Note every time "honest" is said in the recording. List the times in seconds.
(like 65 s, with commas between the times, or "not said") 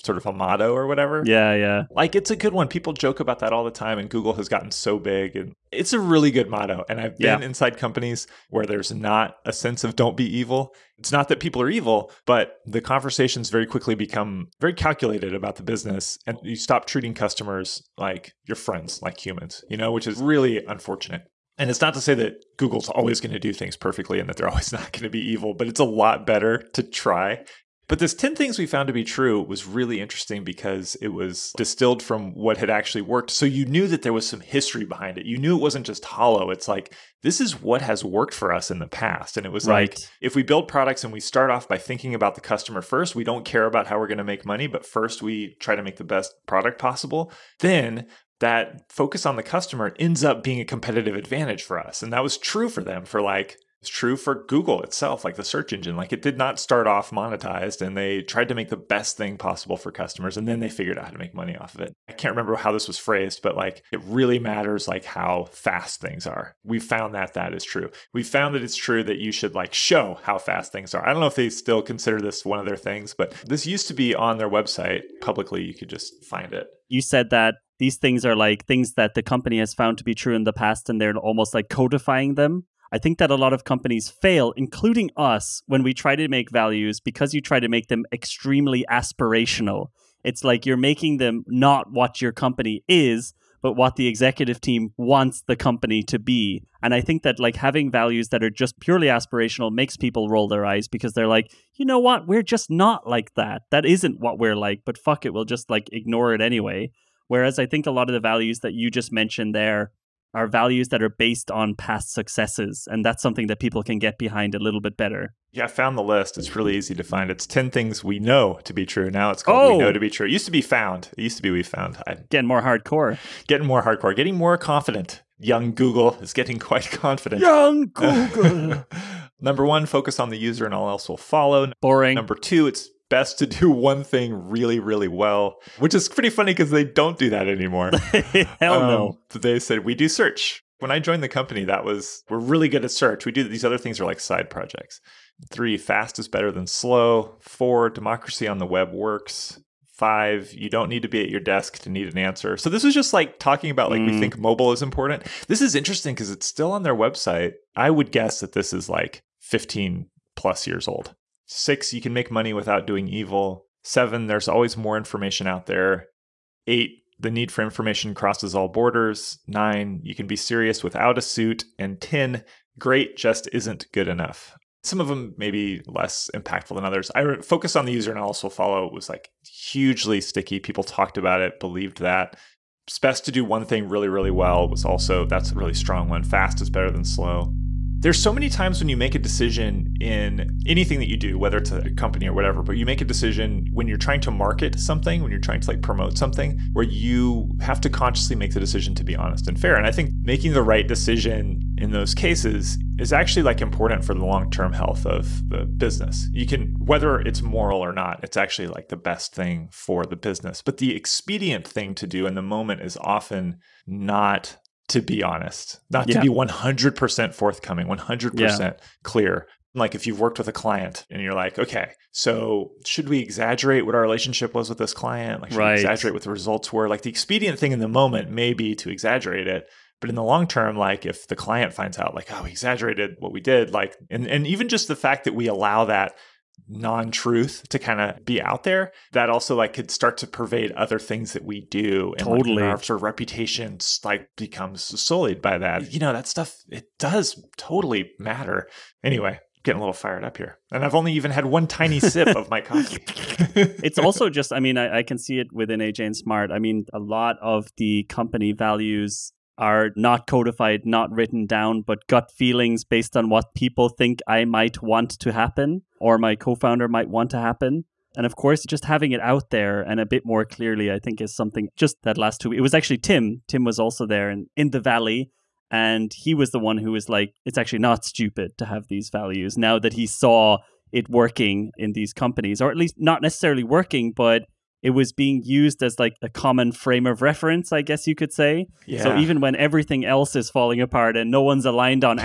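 199 s, 215 s.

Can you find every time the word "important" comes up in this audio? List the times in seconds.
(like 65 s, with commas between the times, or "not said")
154 s, 203 s.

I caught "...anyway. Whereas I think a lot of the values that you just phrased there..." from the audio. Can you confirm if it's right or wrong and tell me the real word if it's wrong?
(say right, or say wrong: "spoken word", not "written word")
wrong: "mentioned", not "phrased".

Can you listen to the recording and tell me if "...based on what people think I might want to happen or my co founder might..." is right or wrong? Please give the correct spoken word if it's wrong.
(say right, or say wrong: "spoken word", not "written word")
right.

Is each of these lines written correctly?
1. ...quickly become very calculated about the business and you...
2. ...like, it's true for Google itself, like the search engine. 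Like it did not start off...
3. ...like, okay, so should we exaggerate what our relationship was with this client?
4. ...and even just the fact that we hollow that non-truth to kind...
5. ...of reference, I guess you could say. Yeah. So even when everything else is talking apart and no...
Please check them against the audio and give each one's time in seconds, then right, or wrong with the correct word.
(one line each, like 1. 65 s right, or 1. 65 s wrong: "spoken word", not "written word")
1. 13 s right
2. 53 s right
3. 221 s right
4. 234 s wrong: "allow", not "hollow"
5. 287 s wrong: "falling", not "talking".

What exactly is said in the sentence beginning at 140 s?
When I joined the company, that was, we're really good at search.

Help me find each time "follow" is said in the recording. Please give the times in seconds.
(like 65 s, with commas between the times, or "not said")
131 s, 178 s.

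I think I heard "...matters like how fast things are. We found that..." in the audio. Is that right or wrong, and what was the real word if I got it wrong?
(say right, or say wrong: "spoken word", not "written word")
right.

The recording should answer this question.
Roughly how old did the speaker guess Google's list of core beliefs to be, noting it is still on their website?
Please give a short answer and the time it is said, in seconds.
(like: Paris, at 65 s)
15 plus years, at 159 s.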